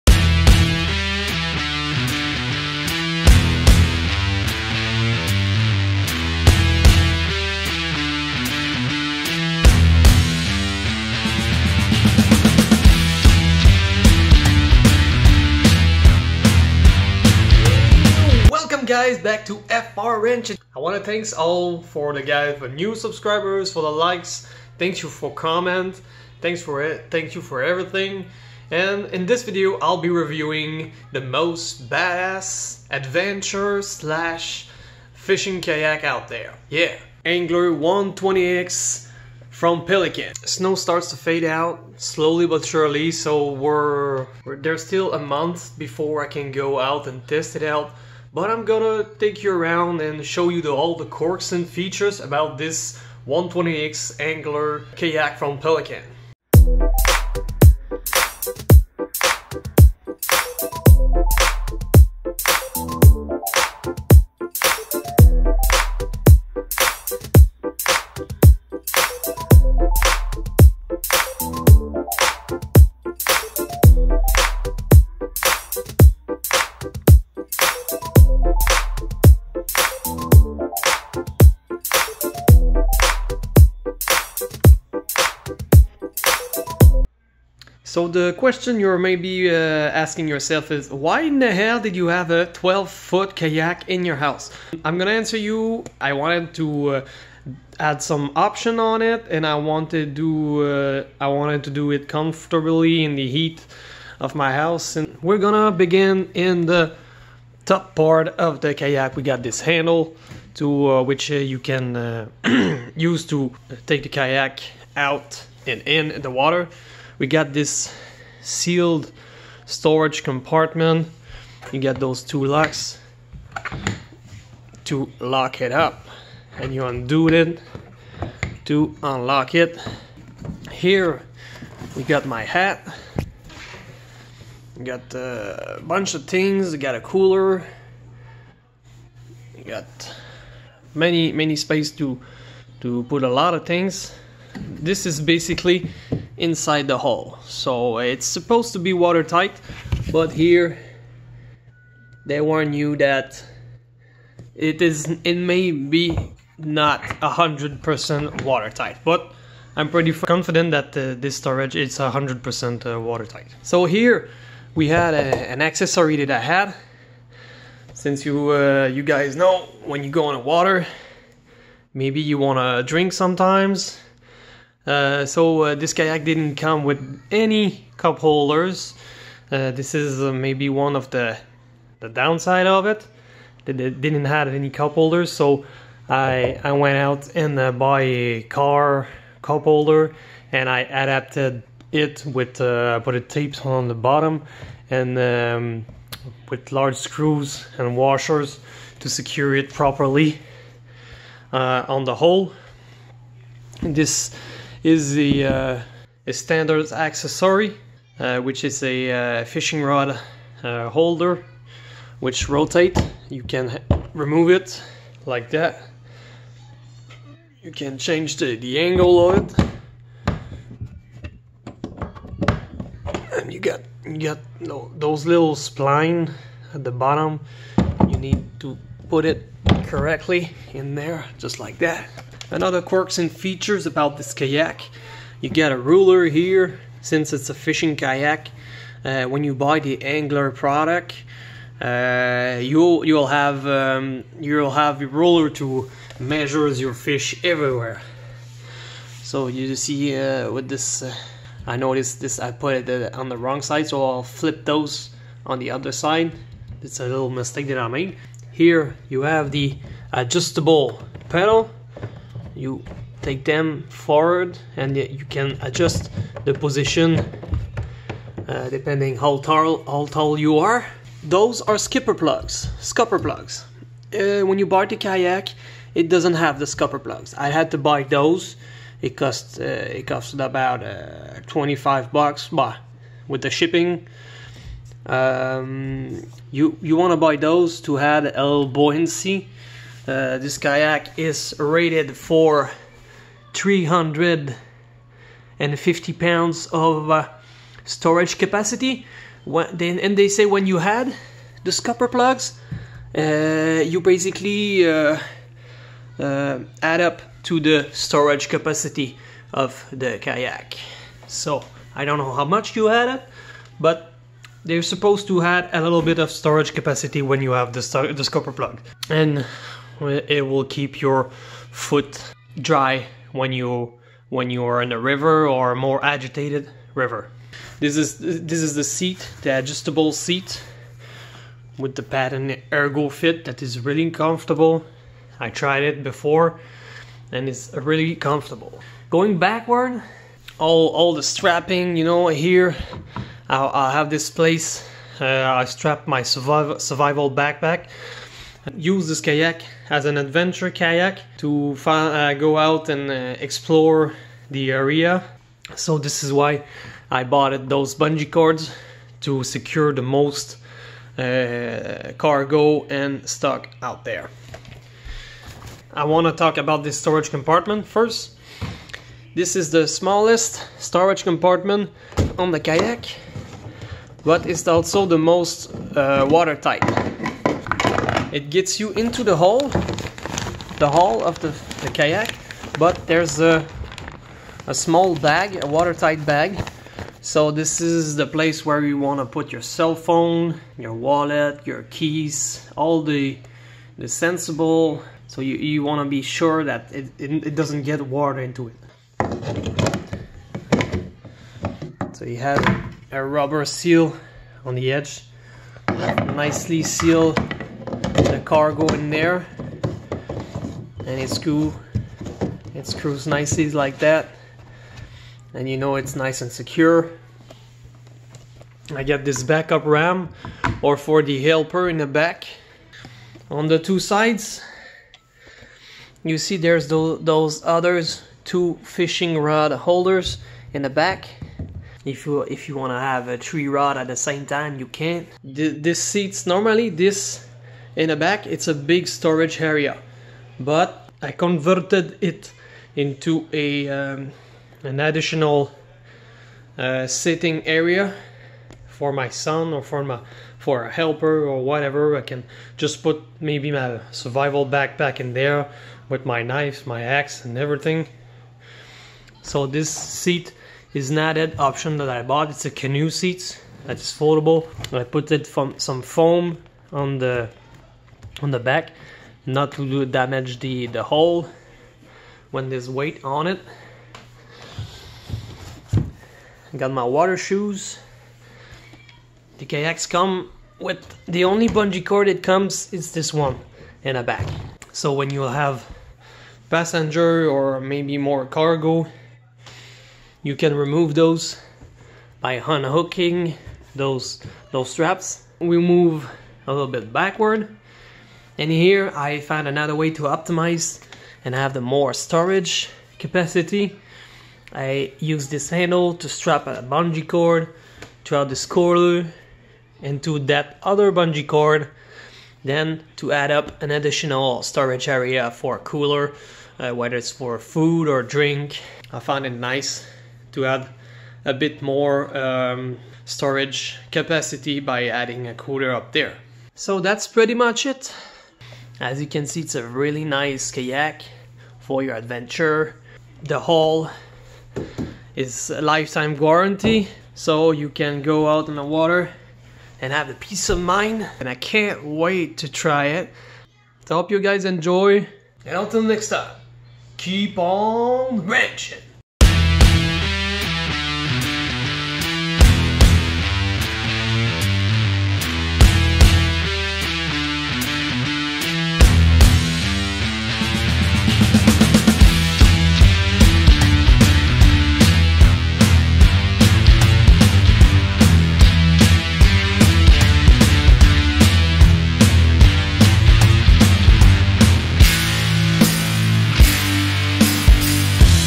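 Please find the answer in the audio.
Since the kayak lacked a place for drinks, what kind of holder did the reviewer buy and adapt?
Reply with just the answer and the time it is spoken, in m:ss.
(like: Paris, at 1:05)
Car cup holder, at 3:08.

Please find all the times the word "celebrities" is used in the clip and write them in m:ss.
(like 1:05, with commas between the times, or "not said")
not said.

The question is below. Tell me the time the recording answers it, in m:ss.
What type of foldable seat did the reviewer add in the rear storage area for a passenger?
7:42.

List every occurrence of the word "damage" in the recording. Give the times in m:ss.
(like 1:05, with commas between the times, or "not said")
7:50.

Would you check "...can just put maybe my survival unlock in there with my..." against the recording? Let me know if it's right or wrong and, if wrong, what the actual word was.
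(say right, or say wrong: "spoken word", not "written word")
wrong: "backpack", not "unlock".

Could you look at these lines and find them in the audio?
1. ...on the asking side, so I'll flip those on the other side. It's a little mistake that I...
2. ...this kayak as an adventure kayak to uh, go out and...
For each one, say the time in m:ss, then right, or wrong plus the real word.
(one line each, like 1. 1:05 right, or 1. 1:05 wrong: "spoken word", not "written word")
1. 4:13 wrong: "wrong", not "asking"
2. 5:49 right.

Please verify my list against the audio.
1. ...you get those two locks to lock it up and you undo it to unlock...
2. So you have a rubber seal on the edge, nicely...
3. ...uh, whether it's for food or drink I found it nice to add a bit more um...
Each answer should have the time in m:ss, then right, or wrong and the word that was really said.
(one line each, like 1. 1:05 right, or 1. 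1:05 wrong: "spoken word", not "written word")
1. 2:01 right
2. 6:42 right
3. 8:36 right.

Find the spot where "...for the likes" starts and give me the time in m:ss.
0:23.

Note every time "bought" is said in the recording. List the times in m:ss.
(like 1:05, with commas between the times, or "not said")
5:57, 7:42.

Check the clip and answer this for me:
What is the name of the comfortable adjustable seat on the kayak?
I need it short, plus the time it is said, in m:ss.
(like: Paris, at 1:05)
ErgoFit, at 5:32.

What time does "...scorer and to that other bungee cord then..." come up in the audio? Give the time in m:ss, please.
8:28.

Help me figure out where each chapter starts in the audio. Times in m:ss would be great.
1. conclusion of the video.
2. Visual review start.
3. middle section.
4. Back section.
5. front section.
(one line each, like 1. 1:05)
1. 8:47
2. 0:56
3. 2:43
4. 5:39
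5. 1:46.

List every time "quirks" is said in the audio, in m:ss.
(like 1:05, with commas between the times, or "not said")
0:51, 3:52.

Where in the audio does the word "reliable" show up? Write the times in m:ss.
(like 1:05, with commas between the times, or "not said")
not said.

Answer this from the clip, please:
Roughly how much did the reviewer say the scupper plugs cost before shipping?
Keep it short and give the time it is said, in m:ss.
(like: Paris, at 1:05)
$25, at 4:41.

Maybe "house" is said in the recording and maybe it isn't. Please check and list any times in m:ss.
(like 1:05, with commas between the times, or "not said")
1:34, 1:44.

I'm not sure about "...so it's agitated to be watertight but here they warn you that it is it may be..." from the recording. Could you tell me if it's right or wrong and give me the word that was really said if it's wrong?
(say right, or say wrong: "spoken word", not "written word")
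wrong: "supposed", not "agitated".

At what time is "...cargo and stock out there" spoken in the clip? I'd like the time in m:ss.
6:02.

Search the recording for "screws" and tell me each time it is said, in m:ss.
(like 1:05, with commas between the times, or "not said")
3:16, 6:52.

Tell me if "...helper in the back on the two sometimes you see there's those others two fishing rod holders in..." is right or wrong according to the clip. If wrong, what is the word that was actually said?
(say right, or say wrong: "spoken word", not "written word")
wrong: "sides", not "sometimes".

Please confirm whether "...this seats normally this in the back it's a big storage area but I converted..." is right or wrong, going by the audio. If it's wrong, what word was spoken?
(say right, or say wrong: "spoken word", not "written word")
right.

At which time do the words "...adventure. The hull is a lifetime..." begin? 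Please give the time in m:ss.
8:52.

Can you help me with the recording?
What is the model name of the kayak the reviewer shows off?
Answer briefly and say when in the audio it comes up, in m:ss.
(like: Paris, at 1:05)
Angler 120X, at 0:37.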